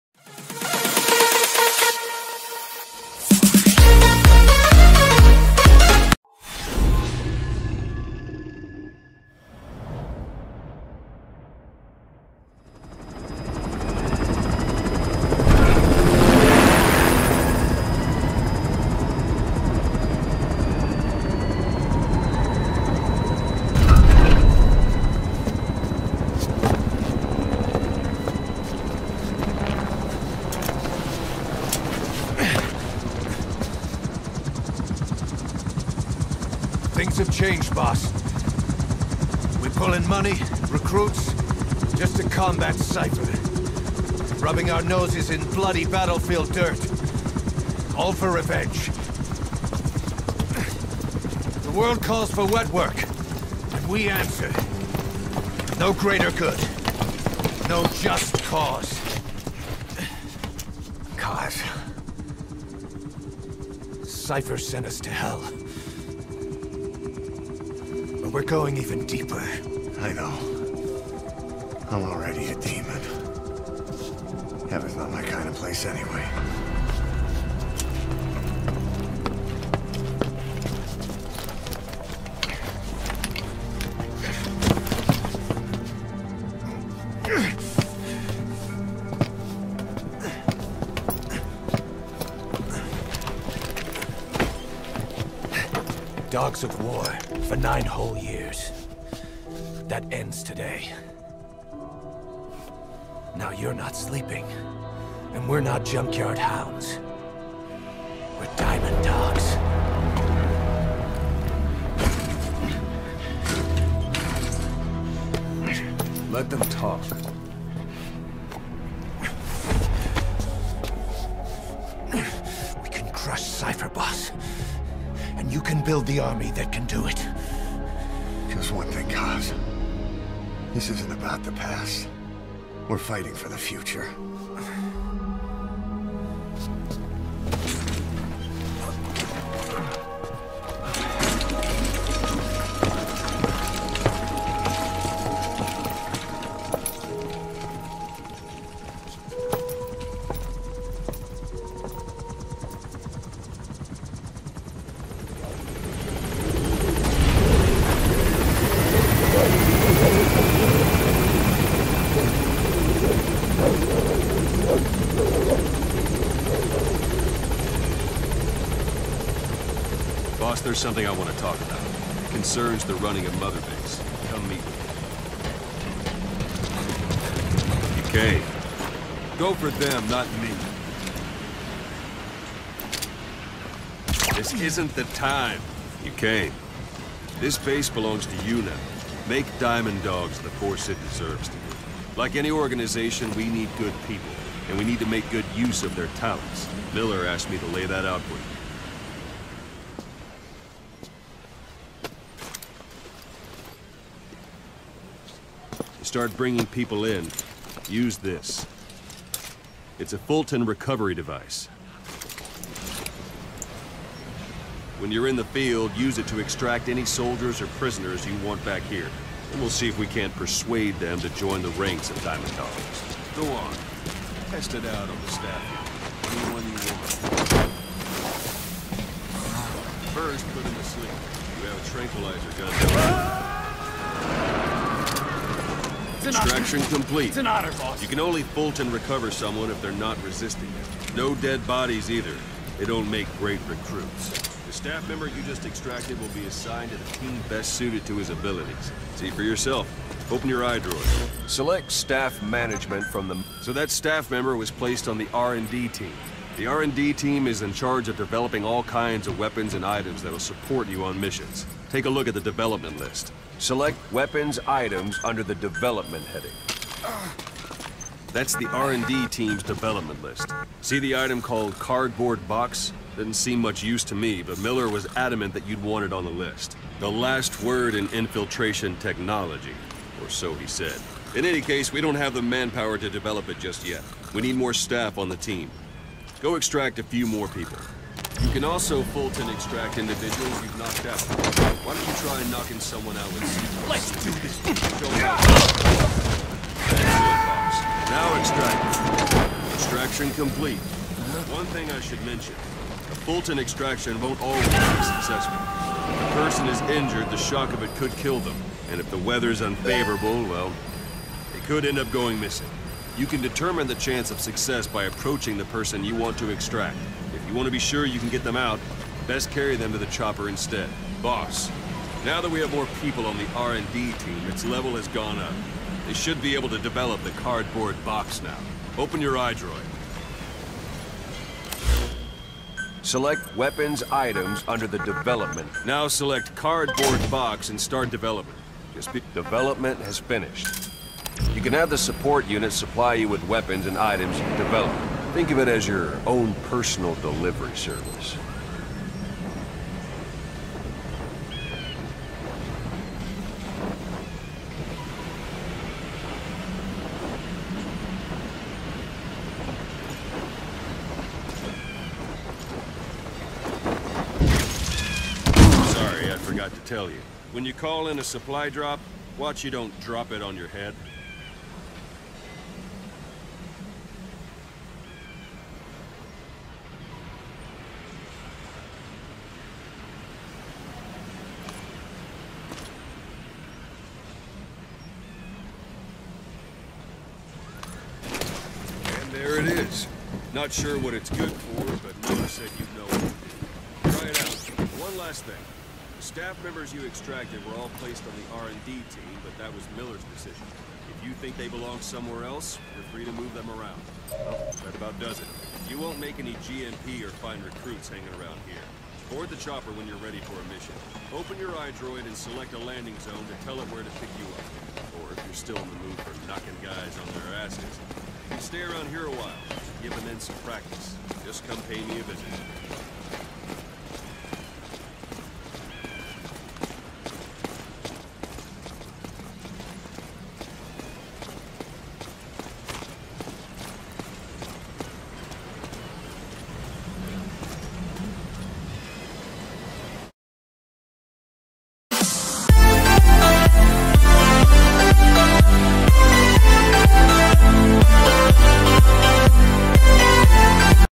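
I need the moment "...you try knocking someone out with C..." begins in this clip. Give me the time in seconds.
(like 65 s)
292 s.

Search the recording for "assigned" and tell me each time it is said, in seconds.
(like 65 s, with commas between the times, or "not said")
246 s.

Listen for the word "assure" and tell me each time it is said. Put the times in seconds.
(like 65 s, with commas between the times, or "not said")
not said.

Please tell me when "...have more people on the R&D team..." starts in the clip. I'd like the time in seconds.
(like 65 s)
322 s.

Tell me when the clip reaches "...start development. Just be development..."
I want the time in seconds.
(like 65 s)
337 s.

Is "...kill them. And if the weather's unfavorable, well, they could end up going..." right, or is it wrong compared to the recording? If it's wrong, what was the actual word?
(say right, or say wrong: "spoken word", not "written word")
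right.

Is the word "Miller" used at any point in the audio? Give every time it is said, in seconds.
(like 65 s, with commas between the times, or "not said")
196 s, 274 s, 392 s, 399 s.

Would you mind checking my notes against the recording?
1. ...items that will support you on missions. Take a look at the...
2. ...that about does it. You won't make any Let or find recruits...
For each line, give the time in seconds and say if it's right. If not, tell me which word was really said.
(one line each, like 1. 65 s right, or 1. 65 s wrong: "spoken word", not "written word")
1. 259 s right
2. 404 s wrong: "GMP", not "Let".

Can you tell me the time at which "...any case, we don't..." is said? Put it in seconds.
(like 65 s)
281 s.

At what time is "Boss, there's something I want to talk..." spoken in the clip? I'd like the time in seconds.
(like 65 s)
170 s.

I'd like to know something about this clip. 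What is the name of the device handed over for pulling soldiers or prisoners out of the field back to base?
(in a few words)
Fulton recovery device.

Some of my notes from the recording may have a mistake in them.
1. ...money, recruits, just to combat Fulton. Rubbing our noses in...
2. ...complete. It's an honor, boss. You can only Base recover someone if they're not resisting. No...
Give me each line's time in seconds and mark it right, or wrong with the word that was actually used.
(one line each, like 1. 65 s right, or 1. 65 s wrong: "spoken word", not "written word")
1. 40 s wrong: "Cypher", not "Fulton"
2. 236 s wrong: "Fulton", not "Base".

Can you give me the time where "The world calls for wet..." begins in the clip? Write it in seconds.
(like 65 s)
51 s.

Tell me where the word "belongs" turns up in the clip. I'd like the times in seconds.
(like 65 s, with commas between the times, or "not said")
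187 s, 401 s.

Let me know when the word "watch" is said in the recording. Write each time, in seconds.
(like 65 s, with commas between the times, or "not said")
369 s.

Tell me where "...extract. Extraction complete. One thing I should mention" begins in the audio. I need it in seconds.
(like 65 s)
298 s.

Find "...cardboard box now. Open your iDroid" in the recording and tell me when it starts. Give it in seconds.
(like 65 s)
327 s.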